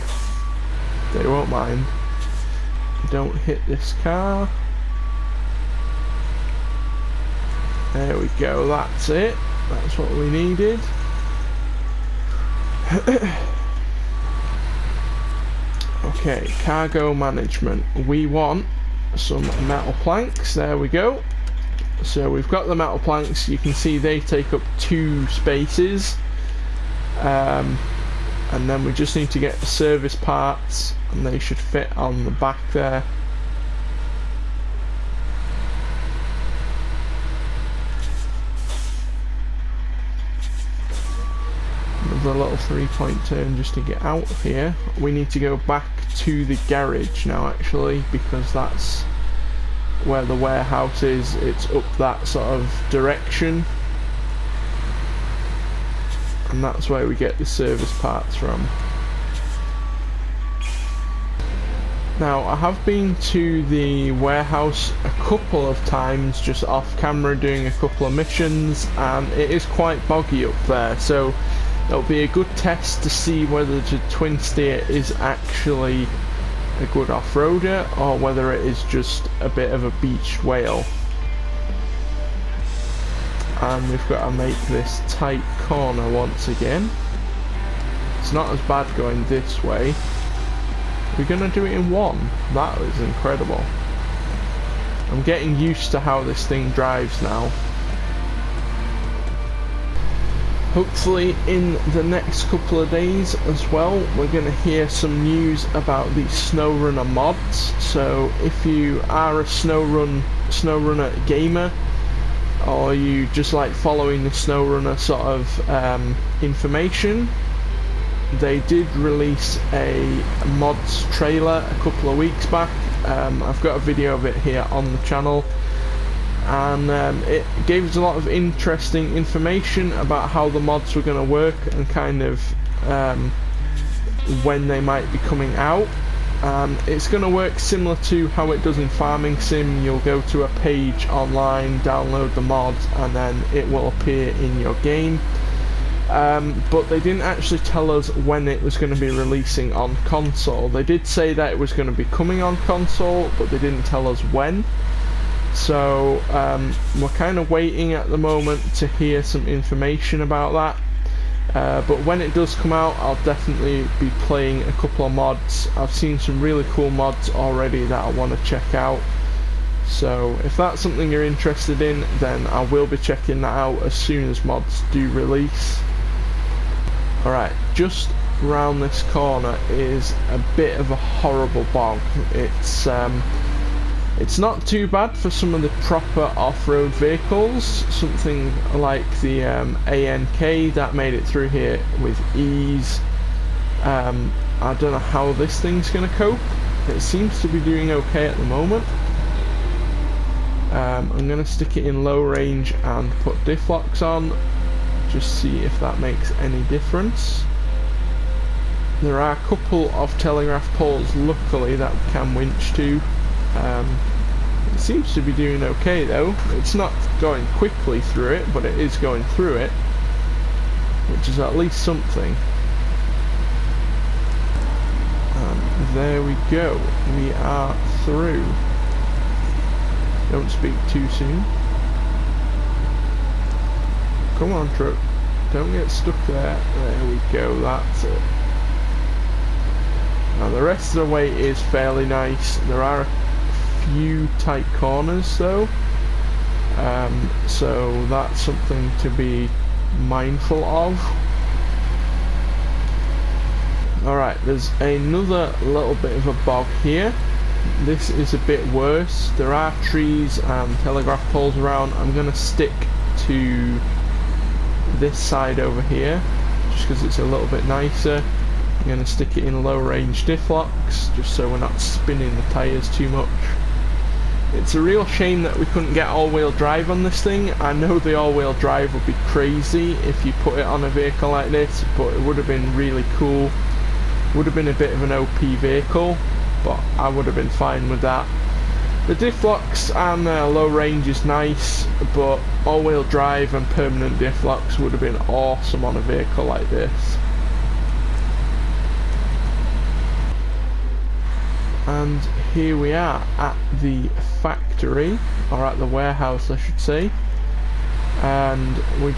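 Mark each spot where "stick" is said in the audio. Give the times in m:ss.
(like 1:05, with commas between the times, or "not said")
3:21, 4:22, 4:29.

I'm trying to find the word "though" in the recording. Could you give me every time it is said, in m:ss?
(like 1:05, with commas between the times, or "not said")
3:36, 4:05.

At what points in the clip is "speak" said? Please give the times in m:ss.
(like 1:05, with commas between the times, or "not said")
3:50.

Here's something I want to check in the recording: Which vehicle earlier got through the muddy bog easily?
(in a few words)
ANK.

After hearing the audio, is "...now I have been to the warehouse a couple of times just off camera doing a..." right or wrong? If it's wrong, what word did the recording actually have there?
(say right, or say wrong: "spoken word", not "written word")
right.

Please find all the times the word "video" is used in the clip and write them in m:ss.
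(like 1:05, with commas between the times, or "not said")
2:03.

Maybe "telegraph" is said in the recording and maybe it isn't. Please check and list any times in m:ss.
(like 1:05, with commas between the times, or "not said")
3:30, 4:20.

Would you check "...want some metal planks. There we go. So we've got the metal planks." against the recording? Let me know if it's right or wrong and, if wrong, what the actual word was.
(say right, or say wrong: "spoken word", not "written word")
right.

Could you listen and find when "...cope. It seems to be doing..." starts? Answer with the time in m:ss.
3:16.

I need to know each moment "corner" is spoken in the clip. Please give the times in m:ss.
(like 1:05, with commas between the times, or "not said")
1:25, 2:59, 4:04.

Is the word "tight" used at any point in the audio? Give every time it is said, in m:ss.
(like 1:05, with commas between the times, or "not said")
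1:25, 4:04.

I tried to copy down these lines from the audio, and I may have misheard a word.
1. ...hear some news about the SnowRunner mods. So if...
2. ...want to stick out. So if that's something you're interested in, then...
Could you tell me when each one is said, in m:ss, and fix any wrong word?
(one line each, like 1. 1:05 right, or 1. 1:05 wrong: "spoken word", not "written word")
1. 1:44 right
2. 2:48 wrong: "check", not "stick".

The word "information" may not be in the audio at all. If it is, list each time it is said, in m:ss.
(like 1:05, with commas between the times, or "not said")
1:56, 2:09, 2:39.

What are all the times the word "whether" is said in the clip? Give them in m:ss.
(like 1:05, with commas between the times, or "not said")
1:13, 1:18.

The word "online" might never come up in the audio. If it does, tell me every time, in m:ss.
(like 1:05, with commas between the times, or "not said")
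2:21.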